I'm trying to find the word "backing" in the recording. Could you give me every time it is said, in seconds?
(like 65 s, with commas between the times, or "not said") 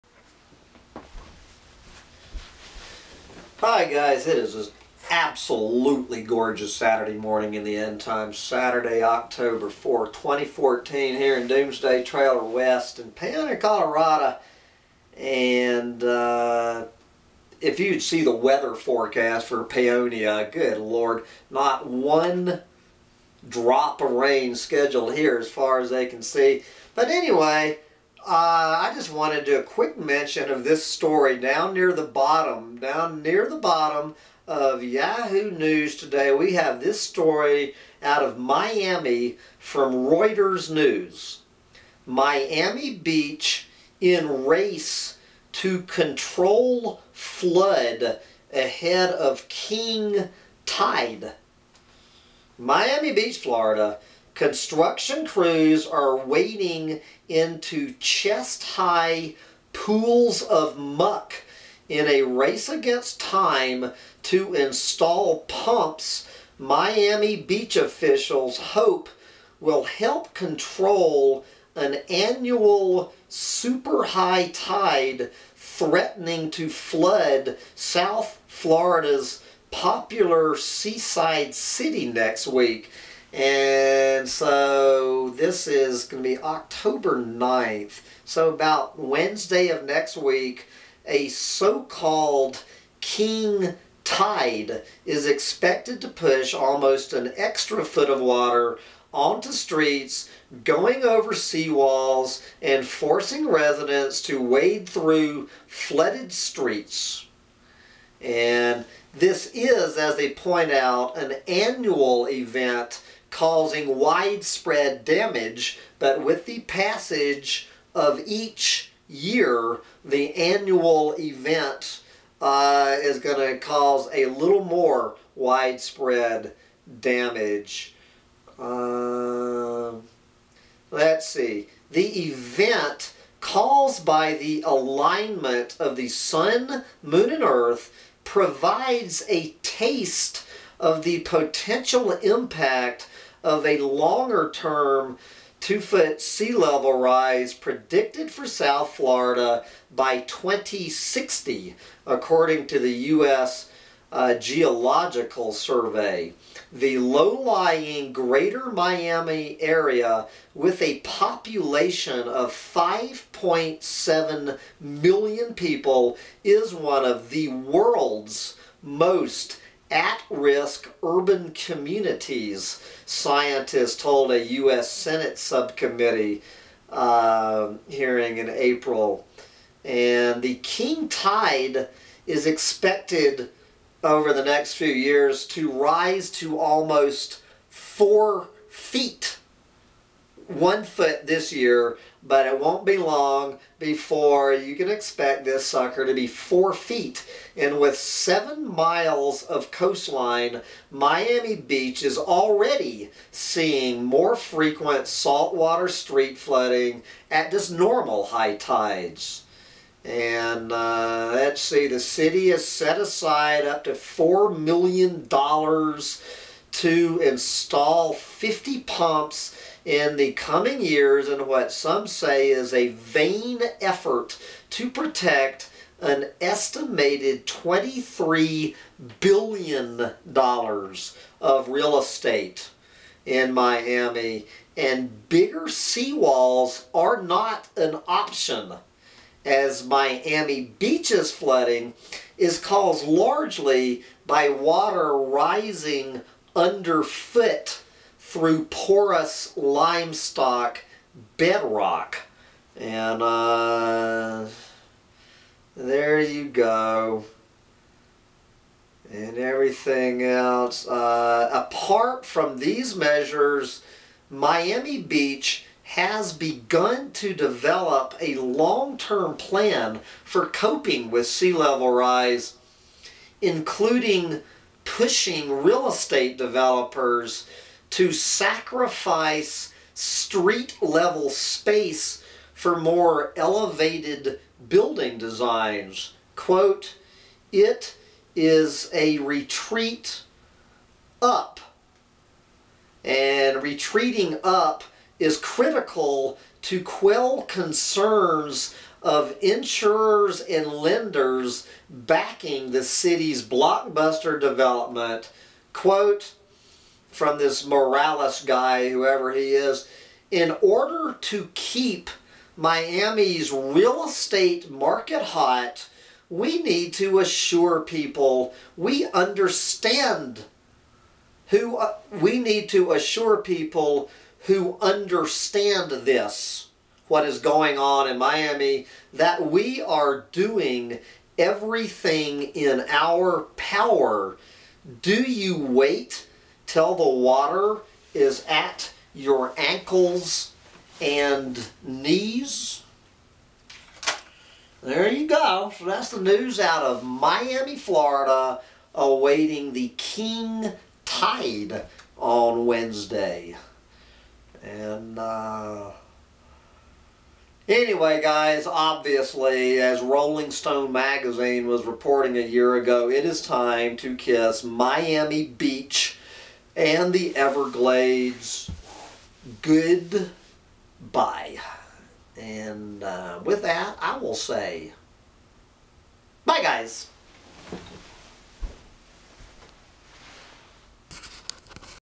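301 s.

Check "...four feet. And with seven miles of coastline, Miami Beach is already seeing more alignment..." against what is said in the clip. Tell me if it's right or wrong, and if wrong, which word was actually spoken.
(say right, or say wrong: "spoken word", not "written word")
wrong: "frequent", not "alignment".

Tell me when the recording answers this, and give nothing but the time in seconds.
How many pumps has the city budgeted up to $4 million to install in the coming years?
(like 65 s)
218 s.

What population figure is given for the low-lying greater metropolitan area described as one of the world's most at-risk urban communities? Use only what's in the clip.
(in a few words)
5.7 million.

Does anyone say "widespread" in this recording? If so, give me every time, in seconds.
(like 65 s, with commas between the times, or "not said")
113 s, 125 s.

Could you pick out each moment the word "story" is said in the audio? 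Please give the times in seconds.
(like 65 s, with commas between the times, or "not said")
30 s, 37 s.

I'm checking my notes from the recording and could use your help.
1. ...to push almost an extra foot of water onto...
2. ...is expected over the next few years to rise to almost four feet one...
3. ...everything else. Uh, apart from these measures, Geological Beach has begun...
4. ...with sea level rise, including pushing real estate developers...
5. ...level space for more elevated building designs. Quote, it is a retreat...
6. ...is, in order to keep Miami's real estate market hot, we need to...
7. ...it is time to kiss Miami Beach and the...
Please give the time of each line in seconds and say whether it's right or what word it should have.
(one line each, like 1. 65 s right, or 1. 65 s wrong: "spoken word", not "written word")
1. 96 s right
2. 182 s right
3. 259 s wrong: "Miami", not "Geological"
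4. 271 s right
5. 280 s right
6. 309 s right
7. 363 s right.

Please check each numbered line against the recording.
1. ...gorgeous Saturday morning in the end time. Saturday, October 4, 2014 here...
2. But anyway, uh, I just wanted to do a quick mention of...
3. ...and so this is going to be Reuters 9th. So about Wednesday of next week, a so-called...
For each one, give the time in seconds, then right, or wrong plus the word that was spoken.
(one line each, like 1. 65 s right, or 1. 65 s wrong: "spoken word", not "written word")
1. 6 s right
2. 26 s right
3. 84 s wrong: "October", not "Reuters".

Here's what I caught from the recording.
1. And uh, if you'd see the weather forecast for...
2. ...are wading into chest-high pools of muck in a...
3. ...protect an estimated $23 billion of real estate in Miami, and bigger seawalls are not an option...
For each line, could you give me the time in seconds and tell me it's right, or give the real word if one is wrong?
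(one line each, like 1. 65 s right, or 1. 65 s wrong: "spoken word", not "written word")
1. 15 s right
2. 55 s right
3. 224 s right.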